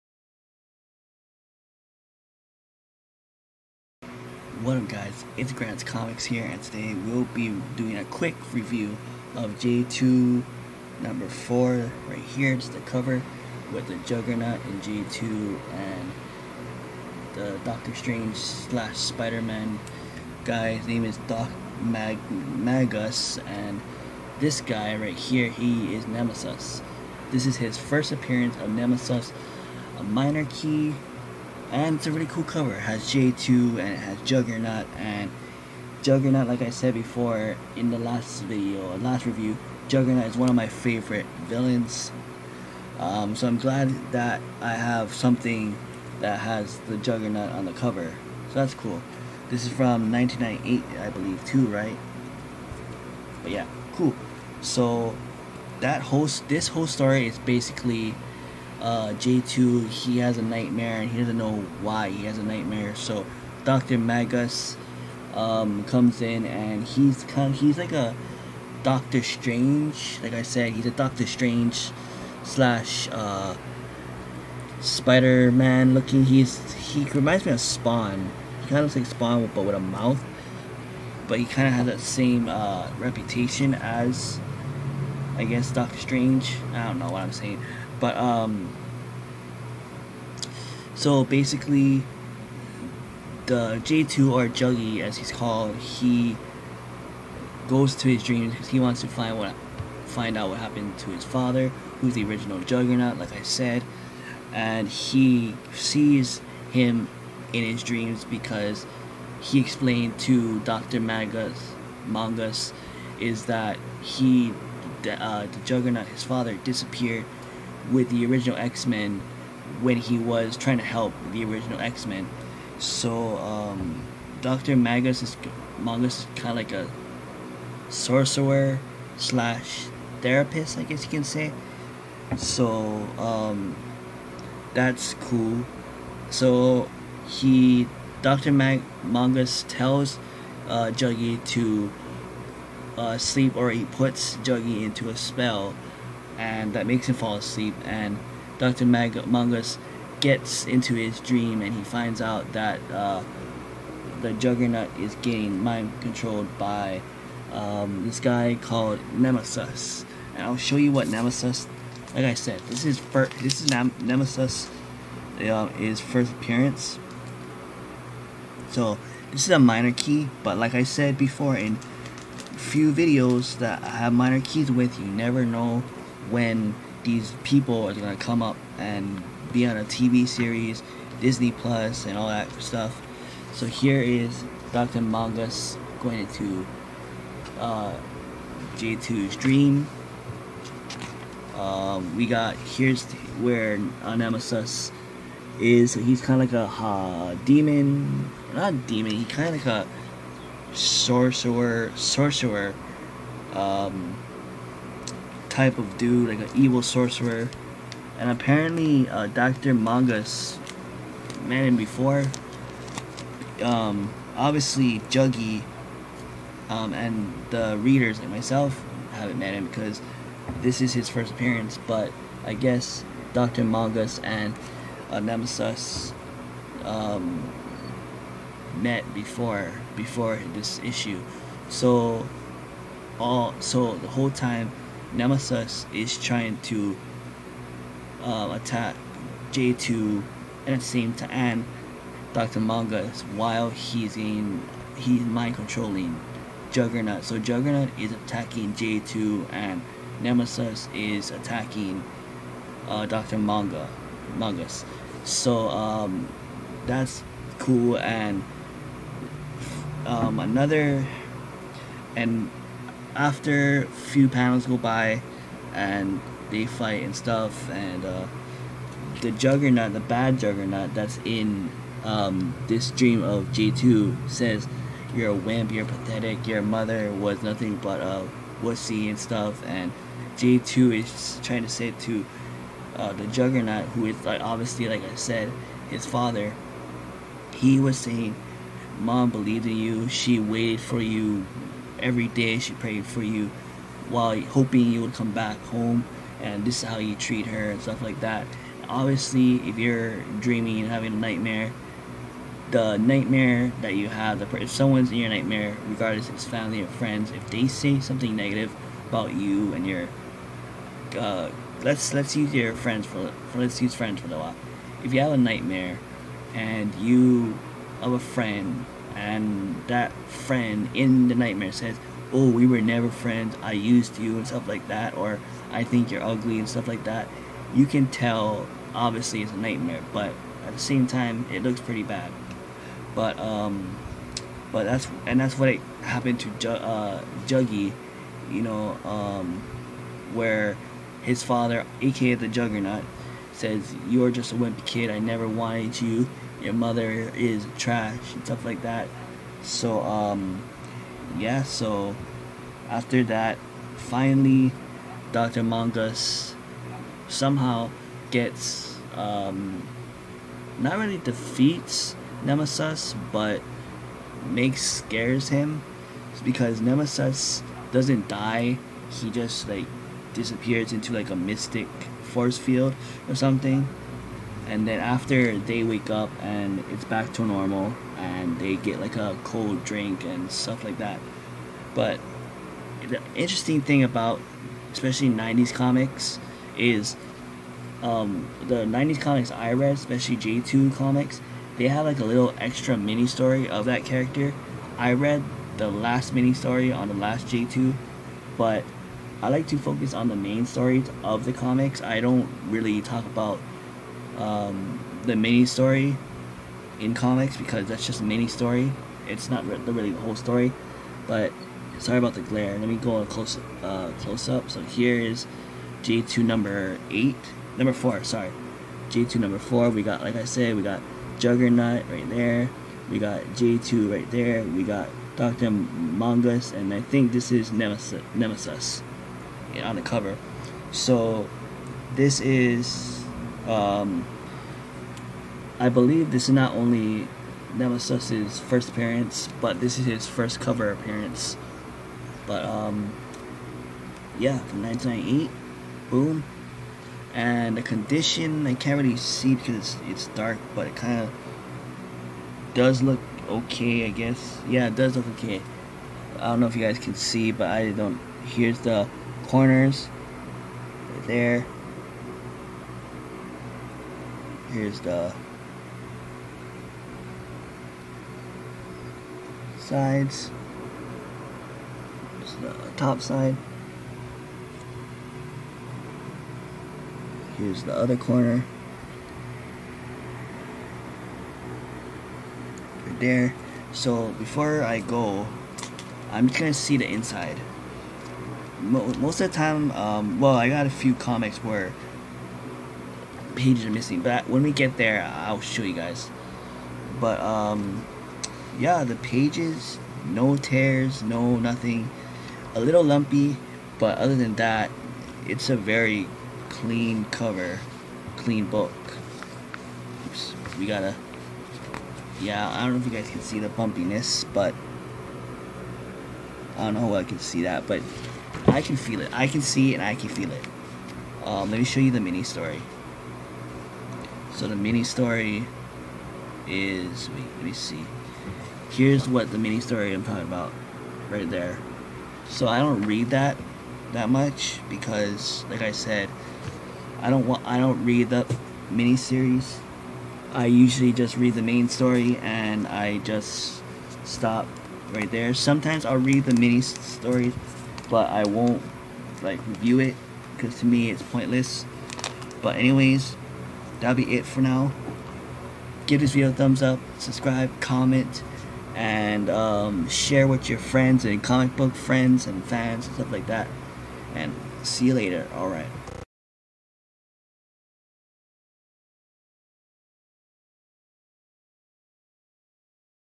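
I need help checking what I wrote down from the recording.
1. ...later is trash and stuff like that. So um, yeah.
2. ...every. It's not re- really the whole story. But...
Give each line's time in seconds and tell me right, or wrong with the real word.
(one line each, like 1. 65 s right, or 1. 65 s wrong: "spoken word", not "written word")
1. 346 s wrong: "mother", not "later"
2. 408 s wrong: "story", not "every".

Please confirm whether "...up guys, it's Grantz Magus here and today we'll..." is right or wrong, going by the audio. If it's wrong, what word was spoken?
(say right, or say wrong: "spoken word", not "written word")
wrong: "Comics", not "Magus".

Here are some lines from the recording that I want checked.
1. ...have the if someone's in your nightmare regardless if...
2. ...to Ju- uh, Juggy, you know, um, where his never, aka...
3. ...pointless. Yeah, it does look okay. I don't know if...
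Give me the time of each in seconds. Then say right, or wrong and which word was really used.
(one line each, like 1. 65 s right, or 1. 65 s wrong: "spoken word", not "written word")
1. 304 s right
2. 336 s wrong: "father", not "never"
3. 454 s wrong: "guess", not "pointless".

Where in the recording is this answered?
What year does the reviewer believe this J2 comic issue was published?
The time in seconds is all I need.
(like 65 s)
49 s.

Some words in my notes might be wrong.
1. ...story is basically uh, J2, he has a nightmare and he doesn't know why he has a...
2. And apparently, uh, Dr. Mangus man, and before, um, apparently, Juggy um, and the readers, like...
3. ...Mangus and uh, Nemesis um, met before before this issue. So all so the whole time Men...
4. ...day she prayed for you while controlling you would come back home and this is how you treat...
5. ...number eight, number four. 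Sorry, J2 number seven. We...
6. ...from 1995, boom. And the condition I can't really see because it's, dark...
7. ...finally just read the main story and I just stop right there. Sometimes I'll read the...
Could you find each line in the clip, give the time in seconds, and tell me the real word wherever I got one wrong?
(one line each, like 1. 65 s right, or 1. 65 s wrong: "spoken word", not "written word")
1. 56 s right
2. 208 s wrong: "obviously", not "apparently"
3. 223 s wrong: "Nemesis", not "Men"
4. 292 s wrong: "hoping", not "controlling"
5. 416 s wrong: "four", not "seven"
6. 444 s wrong: "1998", not "1995"
7. 540 s wrong: "usually", not "finally".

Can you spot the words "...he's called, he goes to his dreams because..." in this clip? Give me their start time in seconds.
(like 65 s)
95 s.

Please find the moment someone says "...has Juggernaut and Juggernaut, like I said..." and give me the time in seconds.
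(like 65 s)
33 s.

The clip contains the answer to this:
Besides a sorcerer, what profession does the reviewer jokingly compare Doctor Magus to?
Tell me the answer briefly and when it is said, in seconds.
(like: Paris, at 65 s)
therapist, at 130 s.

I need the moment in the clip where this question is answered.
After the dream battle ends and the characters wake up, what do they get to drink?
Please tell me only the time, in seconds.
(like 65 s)
379 s.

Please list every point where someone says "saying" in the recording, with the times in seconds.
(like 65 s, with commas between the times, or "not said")
87 s, 287 s.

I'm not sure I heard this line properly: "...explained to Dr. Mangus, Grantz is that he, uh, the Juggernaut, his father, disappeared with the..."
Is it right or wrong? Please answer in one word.
wrong.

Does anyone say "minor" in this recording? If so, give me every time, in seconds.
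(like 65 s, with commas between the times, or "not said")
30 s, 169 s, 174 s.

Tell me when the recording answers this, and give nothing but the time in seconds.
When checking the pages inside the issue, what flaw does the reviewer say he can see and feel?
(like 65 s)
513 s.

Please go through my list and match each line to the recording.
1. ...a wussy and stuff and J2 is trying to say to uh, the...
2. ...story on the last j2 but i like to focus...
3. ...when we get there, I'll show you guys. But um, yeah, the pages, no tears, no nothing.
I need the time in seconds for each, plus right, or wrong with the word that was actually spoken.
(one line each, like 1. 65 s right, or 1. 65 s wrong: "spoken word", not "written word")
1. 278 s right
2. 396 s right
3. 494 s right.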